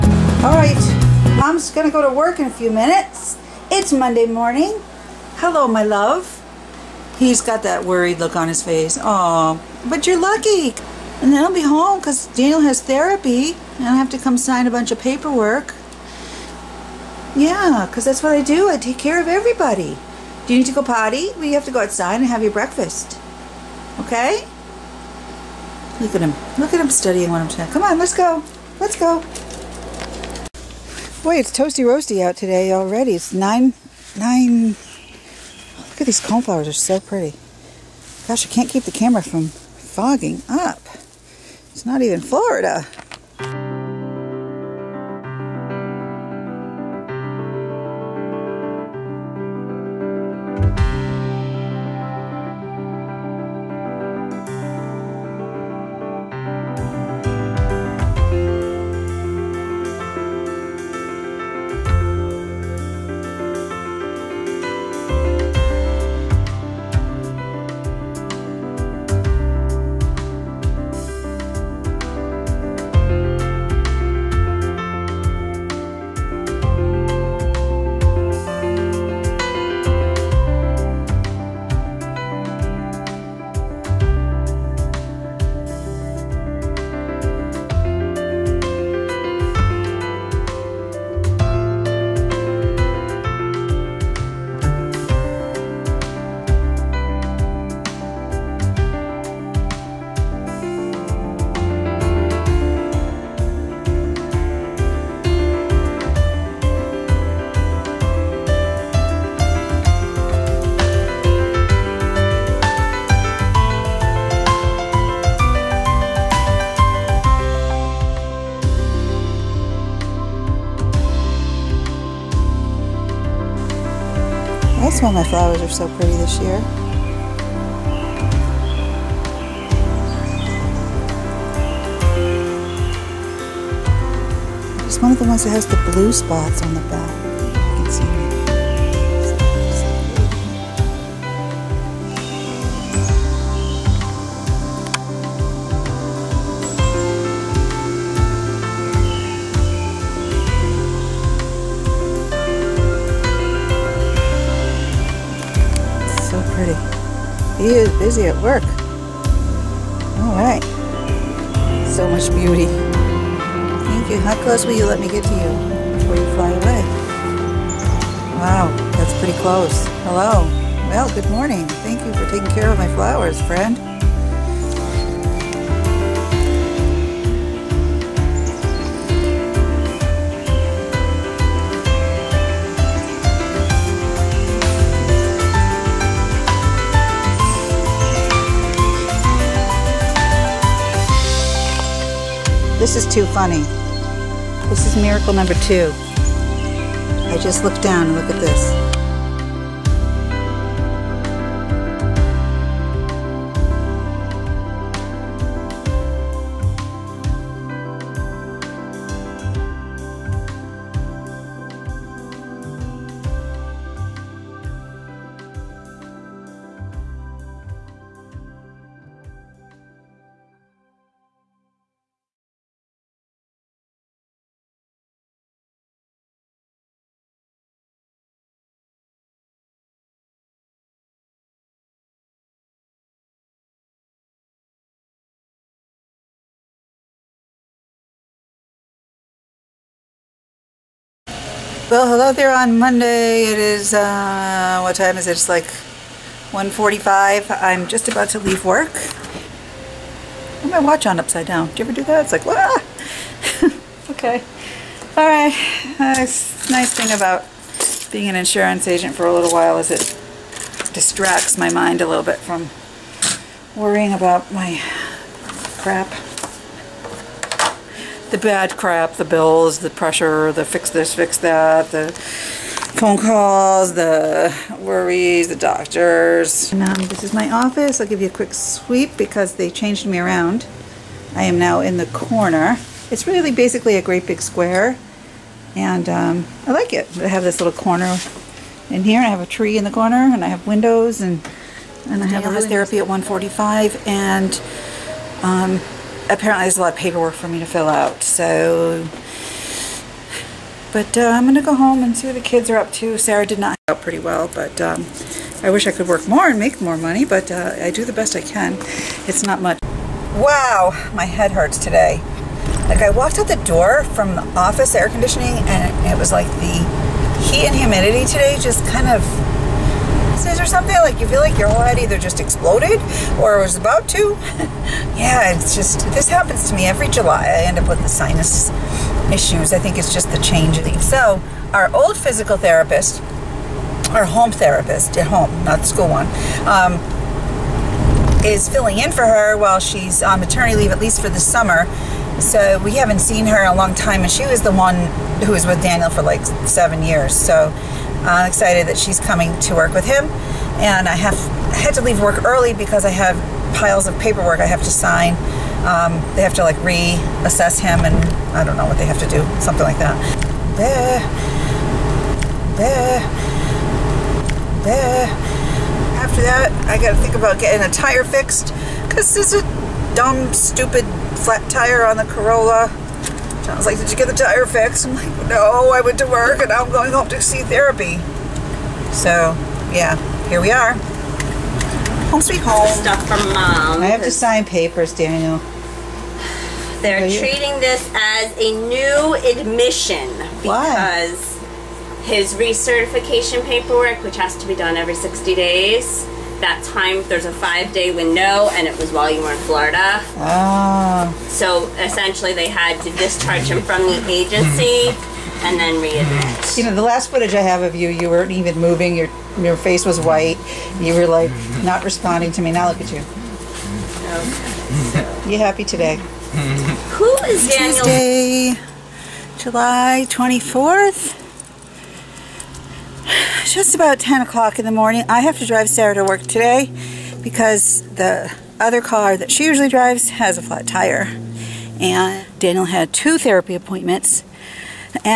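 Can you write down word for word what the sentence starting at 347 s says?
So I'm excited that she's coming to work with him.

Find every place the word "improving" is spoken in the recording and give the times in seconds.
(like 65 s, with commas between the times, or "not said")
not said.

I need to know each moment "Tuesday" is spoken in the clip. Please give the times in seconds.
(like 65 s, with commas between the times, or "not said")
417 s.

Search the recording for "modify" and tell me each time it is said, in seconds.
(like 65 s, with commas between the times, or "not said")
not said.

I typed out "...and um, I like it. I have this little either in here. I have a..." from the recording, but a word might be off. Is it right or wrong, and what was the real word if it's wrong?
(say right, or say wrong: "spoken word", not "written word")
wrong: "corner", not "either".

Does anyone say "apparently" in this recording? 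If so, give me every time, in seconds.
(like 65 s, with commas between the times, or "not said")
296 s.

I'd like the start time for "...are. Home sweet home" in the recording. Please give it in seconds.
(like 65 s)
380 s.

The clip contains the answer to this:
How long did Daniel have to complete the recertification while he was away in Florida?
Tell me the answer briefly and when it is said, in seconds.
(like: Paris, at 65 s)
5 days, at 397 s.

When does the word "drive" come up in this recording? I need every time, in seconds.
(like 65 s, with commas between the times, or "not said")
425 s, 429 s.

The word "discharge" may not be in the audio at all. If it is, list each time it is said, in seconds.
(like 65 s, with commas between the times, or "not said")
403 s.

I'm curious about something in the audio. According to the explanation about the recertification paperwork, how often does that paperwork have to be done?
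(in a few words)
every 60 days.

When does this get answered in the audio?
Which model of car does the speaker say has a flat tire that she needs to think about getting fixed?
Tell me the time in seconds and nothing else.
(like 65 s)
372 s.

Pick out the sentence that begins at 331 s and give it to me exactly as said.
So our old physical therapist, our home therapist at home, not the school one.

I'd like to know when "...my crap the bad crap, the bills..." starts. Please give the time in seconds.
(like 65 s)
264 s.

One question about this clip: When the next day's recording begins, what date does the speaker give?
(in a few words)
July 24th.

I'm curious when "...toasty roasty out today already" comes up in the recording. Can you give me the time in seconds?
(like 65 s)
31 s.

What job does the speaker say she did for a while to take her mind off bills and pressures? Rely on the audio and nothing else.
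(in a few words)
insurance agent.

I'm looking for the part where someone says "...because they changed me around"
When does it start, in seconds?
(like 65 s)
279 s.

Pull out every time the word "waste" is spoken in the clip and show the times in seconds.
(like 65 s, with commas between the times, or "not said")
not said.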